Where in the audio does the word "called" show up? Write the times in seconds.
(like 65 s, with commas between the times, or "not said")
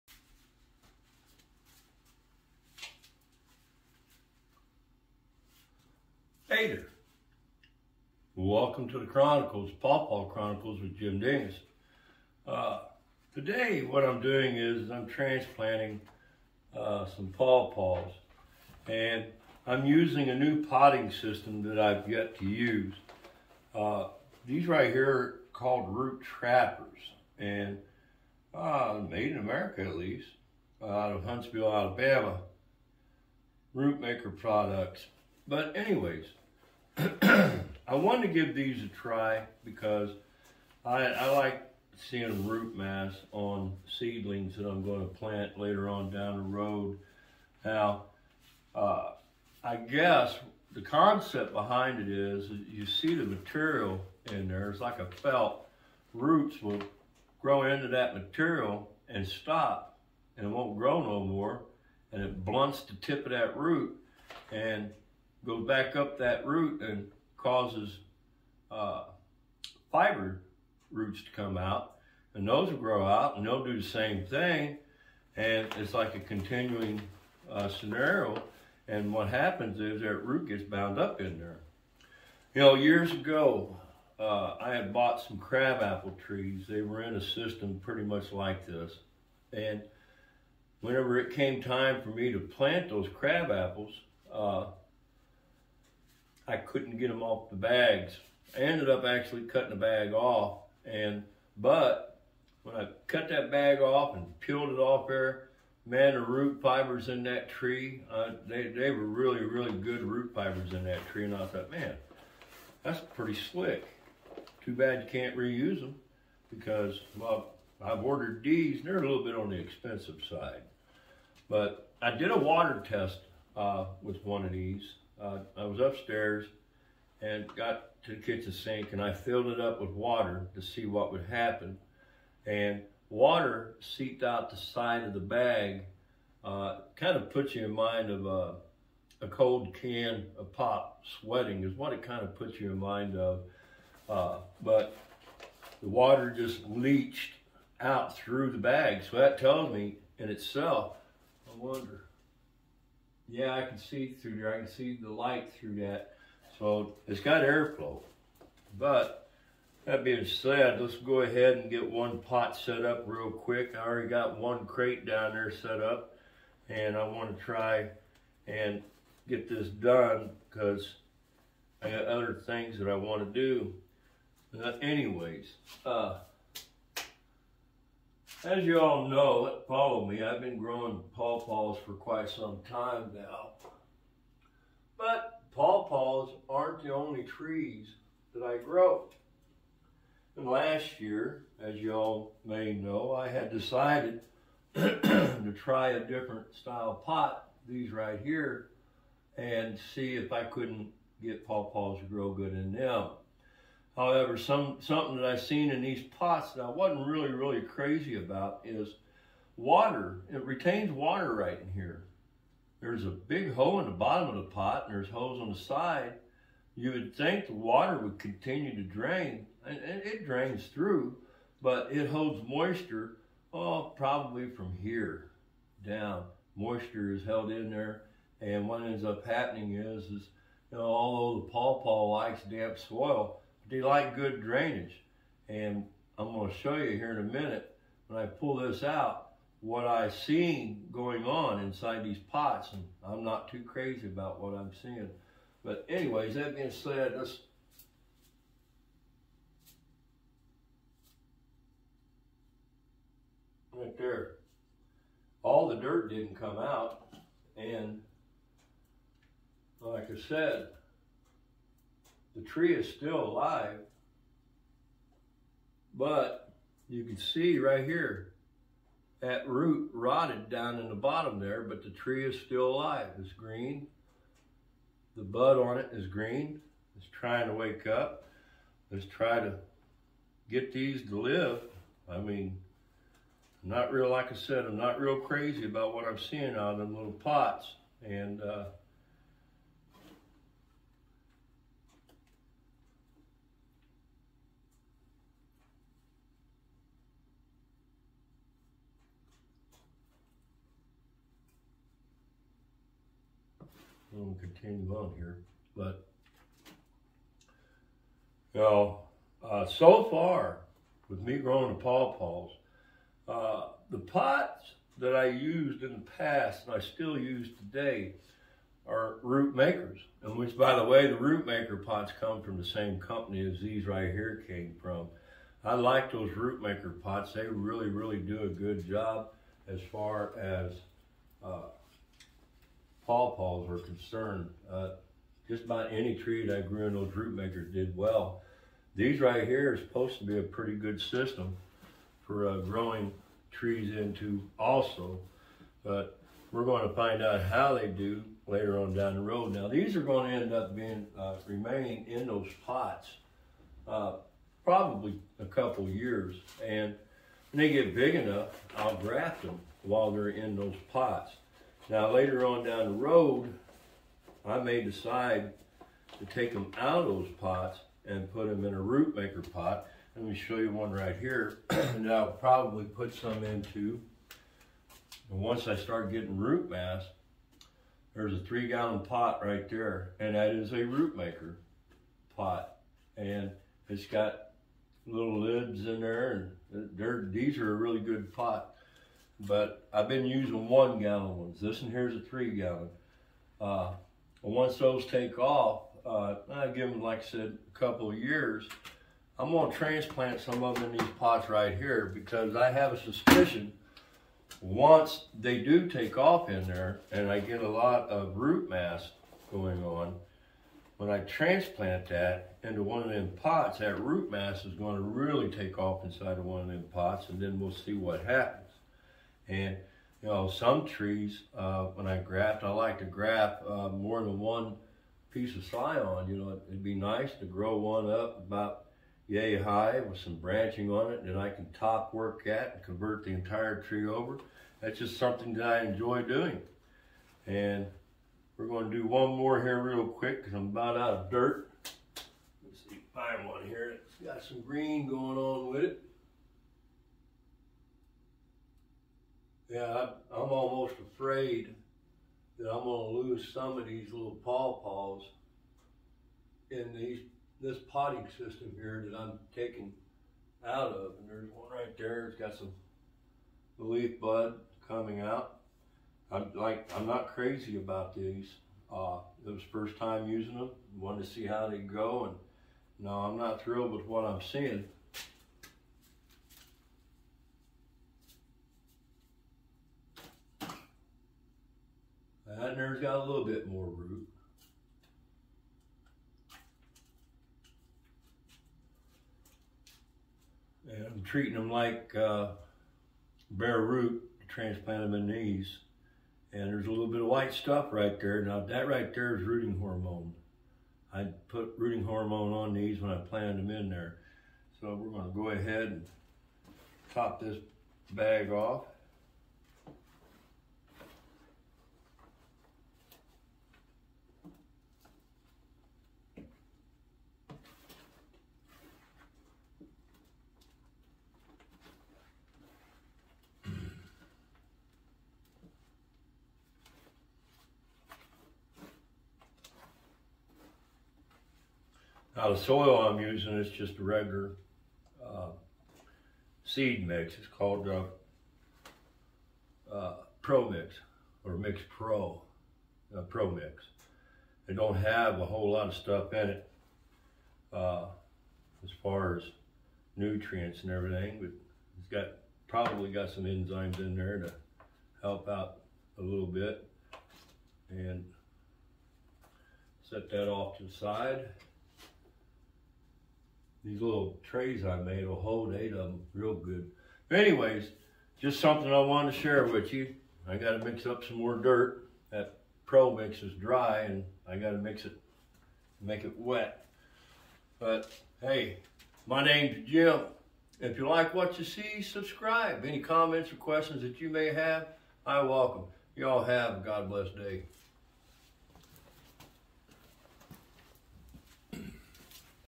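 25 s, 537 s.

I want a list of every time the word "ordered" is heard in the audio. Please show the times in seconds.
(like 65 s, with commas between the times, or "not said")
118 s.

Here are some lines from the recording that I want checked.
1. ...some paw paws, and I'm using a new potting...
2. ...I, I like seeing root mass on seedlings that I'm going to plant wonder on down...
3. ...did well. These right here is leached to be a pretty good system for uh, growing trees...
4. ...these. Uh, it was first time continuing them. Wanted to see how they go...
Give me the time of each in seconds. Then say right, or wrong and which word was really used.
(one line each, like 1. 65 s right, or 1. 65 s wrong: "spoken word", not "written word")
1. 17 s right
2. 40 s wrong: "later", not "wonder"
3. 337 s wrong: "supposed", not "leached"
4. 468 s wrong: "using", not "continuing".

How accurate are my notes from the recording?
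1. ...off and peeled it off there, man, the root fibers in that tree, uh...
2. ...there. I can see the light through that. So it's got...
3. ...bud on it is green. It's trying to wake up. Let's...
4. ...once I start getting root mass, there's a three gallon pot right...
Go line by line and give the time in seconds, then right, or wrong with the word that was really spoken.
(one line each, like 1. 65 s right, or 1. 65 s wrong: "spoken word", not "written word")
1. 103 s right
2. 154 s right
3. 275 s right
4. 375 s right.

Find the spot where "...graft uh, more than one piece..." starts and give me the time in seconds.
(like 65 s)
423 s.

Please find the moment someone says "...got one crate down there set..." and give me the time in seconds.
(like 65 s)
164 s.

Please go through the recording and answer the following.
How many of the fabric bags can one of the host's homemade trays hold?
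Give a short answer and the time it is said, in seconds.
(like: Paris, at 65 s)
8, at 565 s.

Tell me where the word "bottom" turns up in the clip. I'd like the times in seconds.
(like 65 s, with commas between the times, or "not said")
213 s, 270 s.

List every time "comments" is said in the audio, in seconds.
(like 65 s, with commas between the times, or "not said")
582 s.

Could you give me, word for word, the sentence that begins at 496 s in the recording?
And there's a little bit of white stuff right there.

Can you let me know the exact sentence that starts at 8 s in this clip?
Welcome to the Chronicles, Paw Paw Chronicles with Jim Dingus.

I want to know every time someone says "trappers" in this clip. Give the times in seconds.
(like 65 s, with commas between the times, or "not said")
26 s.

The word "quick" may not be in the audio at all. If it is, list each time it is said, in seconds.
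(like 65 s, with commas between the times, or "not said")
163 s, 440 s.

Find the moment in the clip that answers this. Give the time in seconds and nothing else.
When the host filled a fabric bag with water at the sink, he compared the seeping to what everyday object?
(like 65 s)
139 s.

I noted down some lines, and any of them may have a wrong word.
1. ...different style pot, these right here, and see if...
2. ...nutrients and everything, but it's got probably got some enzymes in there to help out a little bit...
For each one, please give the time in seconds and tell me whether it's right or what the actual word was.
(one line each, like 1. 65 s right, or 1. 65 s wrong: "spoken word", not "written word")
1. 195 s right
2. 550 s right.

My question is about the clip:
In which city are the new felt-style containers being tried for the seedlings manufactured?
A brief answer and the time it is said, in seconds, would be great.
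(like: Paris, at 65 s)
Huntsville, Alabama, at 31 s.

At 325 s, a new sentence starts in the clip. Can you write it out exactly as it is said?
I like those root maker pots.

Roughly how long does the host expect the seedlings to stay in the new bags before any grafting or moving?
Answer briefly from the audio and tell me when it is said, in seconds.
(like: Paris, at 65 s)
A couple years, at 355 s.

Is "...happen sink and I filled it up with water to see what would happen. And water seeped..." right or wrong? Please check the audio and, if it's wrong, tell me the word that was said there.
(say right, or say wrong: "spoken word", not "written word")
wrong: "kitchen", not "happen".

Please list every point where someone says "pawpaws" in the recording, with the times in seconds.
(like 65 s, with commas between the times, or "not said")
181 s, 185 s, 201 s, 231 s, 311 s, 333 s, 454 s.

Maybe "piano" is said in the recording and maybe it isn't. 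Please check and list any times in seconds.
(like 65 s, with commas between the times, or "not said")
not said.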